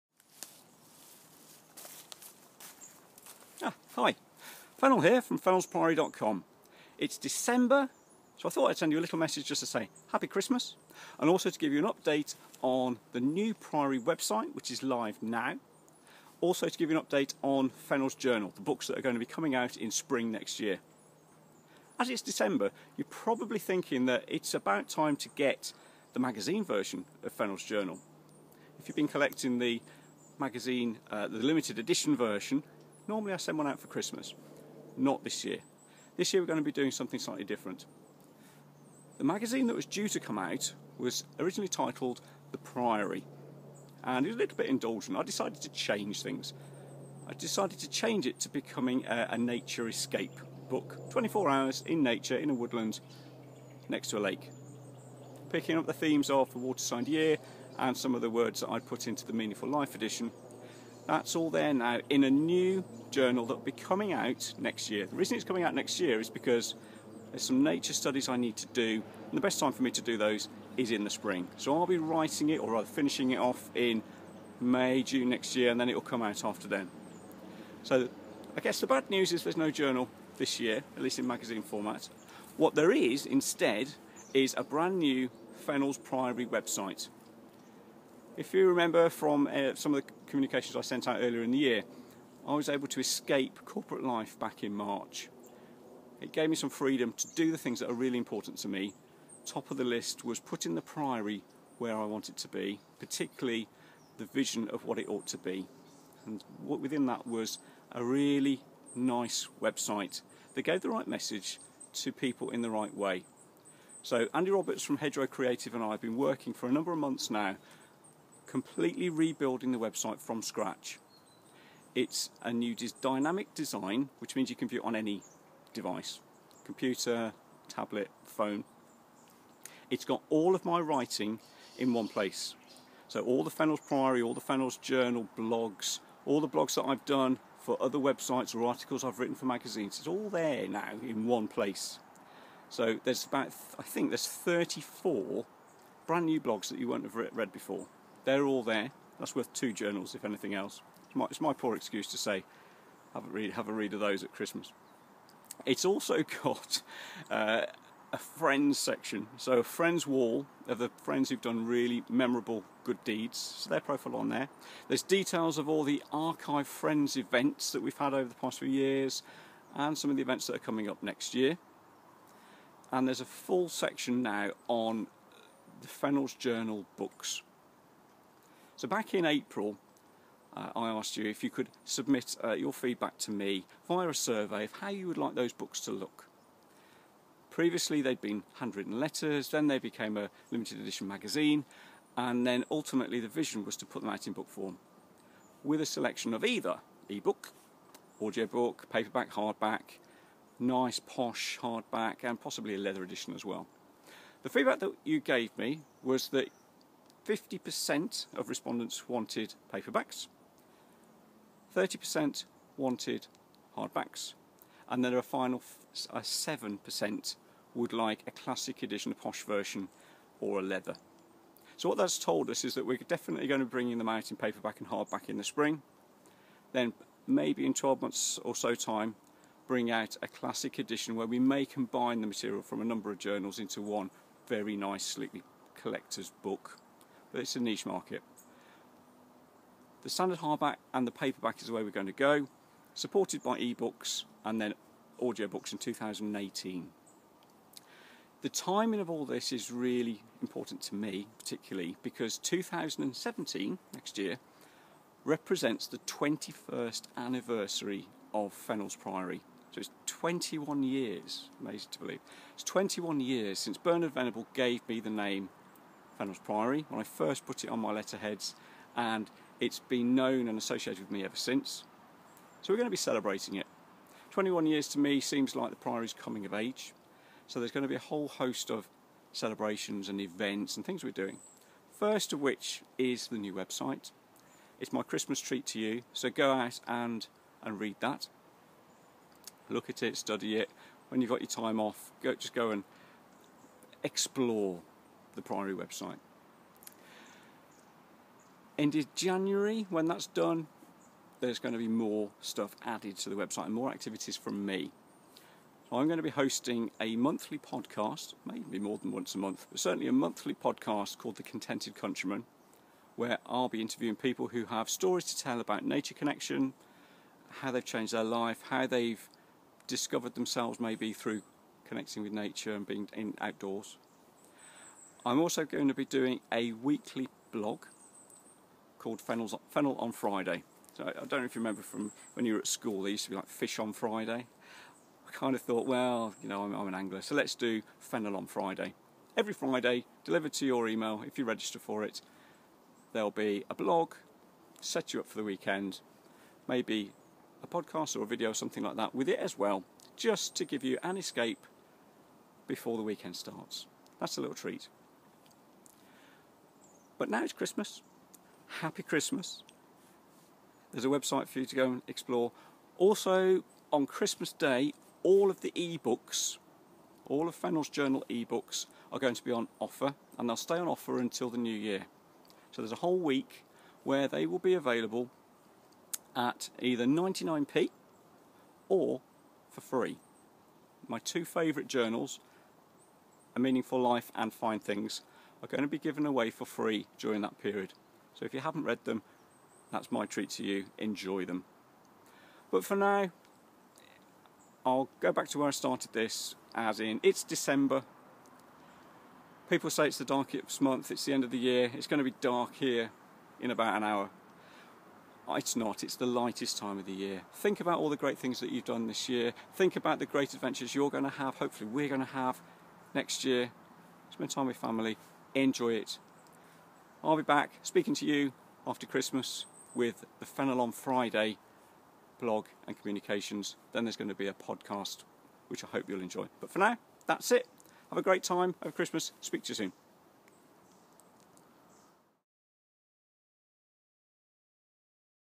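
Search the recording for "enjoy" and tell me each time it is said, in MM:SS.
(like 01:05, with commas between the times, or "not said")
06:30, 06:55, 07:06.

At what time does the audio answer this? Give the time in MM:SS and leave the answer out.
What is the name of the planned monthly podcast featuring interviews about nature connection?
05:11.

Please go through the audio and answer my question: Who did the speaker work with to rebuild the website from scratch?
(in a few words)
Andy Roberts.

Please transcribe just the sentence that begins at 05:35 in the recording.
I kind of thought, well, you know, I'm, I'm an angler, so let's do Fennel on Friday.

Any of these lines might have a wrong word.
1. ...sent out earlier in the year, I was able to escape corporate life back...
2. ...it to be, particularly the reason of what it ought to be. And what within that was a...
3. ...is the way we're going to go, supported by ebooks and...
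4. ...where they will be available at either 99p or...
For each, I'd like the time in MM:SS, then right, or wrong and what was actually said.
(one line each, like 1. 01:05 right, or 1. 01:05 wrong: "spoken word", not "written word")
1. 01:30 right
2. 01:42 wrong: "vision", not "reason"
3. 04:01 right
4. 06:14 right.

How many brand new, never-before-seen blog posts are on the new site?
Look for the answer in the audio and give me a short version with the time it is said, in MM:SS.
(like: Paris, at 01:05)
34, at 02:24.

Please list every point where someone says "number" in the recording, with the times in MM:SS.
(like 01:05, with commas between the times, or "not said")
01:56, 03:52.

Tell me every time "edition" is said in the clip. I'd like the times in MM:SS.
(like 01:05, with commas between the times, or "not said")
00:31, 00:59, 03:10, 03:23, 03:38, 03:50.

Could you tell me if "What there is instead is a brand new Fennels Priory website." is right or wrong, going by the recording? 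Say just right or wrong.
right.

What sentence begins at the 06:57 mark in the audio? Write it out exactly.
I'll be back speaking to you after Christmas with the Fennel on Friday blog and communications.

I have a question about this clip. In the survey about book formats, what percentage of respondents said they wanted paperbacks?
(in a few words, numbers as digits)
50%.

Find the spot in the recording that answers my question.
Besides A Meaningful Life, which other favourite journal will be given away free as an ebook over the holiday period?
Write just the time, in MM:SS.
06:24.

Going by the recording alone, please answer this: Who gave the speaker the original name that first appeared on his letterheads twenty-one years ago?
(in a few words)
Bernard Venables.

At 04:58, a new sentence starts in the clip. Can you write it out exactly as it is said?
End of January, when that's done, there's going to be more stuff added to the website and more activities from me.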